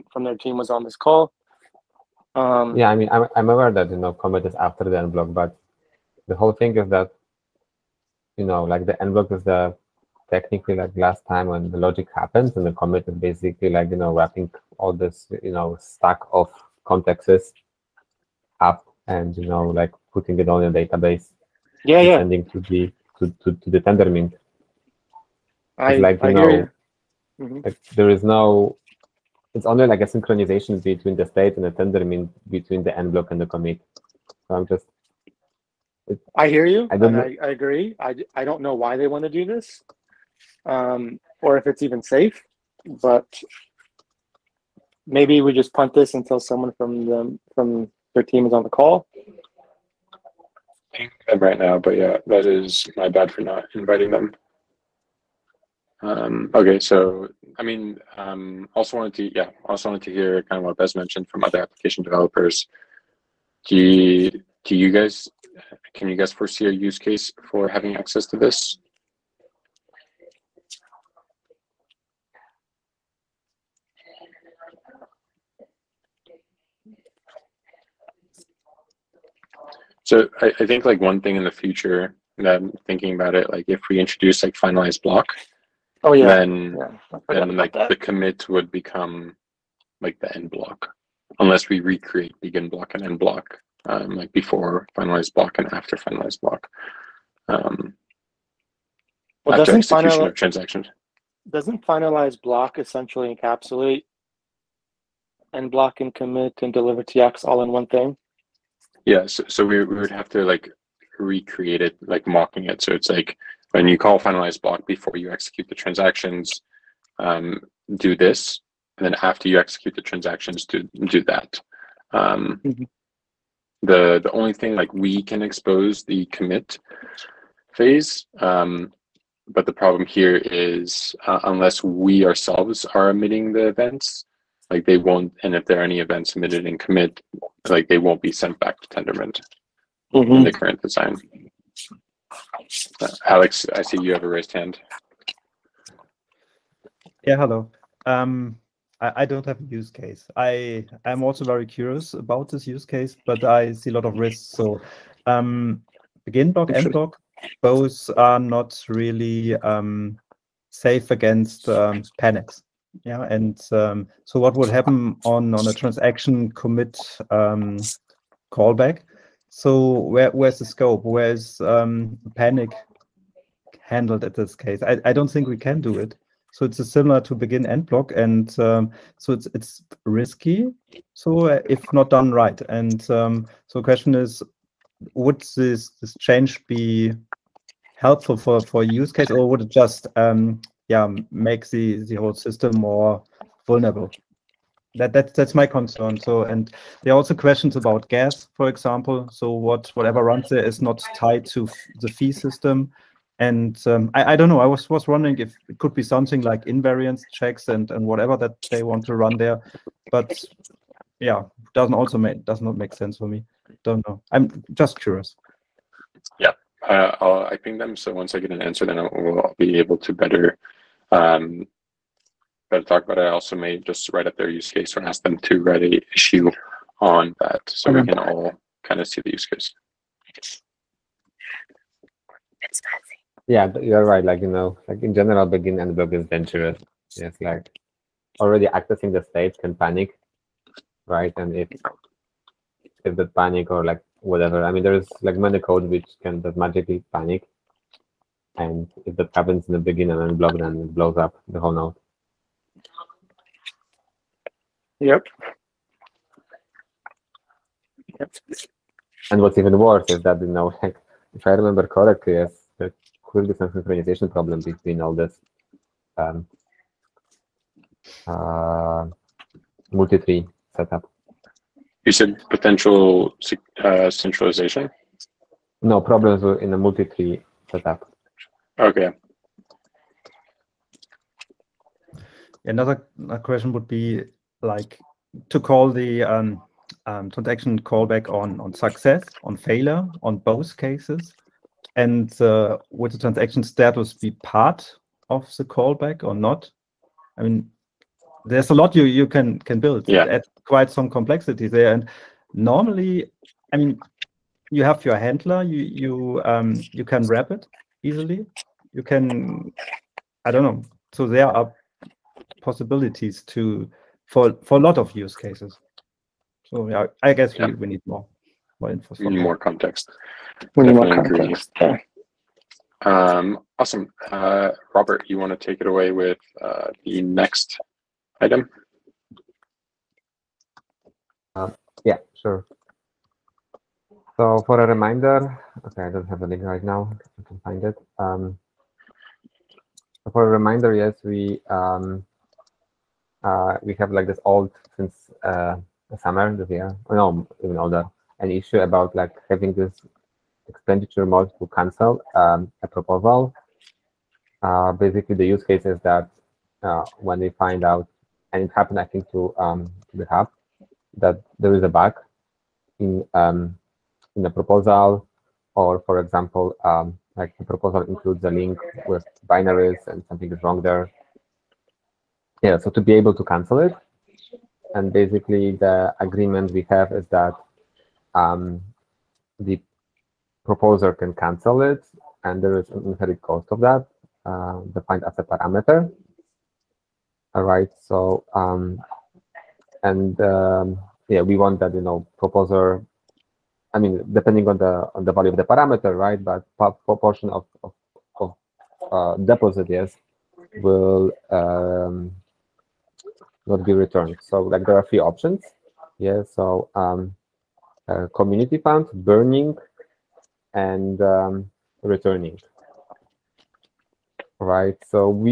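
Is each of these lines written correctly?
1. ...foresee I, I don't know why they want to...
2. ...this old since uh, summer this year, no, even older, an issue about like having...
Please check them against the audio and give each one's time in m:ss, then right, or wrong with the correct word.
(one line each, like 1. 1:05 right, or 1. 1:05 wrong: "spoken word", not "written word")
1. 0:37 wrong: "agree", not "foresee"
2. 5:44 right.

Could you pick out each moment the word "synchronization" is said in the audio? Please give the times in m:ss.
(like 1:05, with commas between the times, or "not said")
0:30, 4:23.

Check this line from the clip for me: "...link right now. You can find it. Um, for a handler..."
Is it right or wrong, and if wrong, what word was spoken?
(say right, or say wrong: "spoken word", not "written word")
wrong: "reminder", not "handler".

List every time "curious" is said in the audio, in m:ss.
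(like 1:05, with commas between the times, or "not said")
2:31, 3:35.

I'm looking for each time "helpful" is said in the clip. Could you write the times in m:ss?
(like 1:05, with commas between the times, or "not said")
3:07.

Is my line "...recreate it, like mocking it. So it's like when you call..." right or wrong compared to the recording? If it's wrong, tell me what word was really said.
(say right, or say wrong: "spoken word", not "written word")
right.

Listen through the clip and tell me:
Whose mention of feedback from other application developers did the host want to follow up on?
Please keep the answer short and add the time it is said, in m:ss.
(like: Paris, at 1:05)
Bez, at 1:00.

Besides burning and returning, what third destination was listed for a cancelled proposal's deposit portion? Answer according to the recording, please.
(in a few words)
community fund.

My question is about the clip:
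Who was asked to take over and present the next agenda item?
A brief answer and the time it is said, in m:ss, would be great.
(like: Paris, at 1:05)
Robert, at 5:24.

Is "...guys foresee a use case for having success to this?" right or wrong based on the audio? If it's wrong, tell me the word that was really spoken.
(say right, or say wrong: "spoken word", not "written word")
wrong: "access", not "success".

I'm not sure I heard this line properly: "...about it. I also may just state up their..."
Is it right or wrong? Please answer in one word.
wrong.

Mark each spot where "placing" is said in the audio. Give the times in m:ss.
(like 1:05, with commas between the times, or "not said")
not said.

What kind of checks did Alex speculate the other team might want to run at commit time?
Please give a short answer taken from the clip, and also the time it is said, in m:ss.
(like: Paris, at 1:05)
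invariance checks, at 3:26.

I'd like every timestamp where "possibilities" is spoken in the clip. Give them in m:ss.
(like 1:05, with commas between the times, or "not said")
5:12.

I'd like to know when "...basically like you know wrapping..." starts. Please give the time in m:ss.
0:13.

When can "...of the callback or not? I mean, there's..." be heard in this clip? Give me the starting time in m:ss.
4:55.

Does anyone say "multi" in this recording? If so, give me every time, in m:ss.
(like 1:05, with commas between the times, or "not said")
4:29, 4:36.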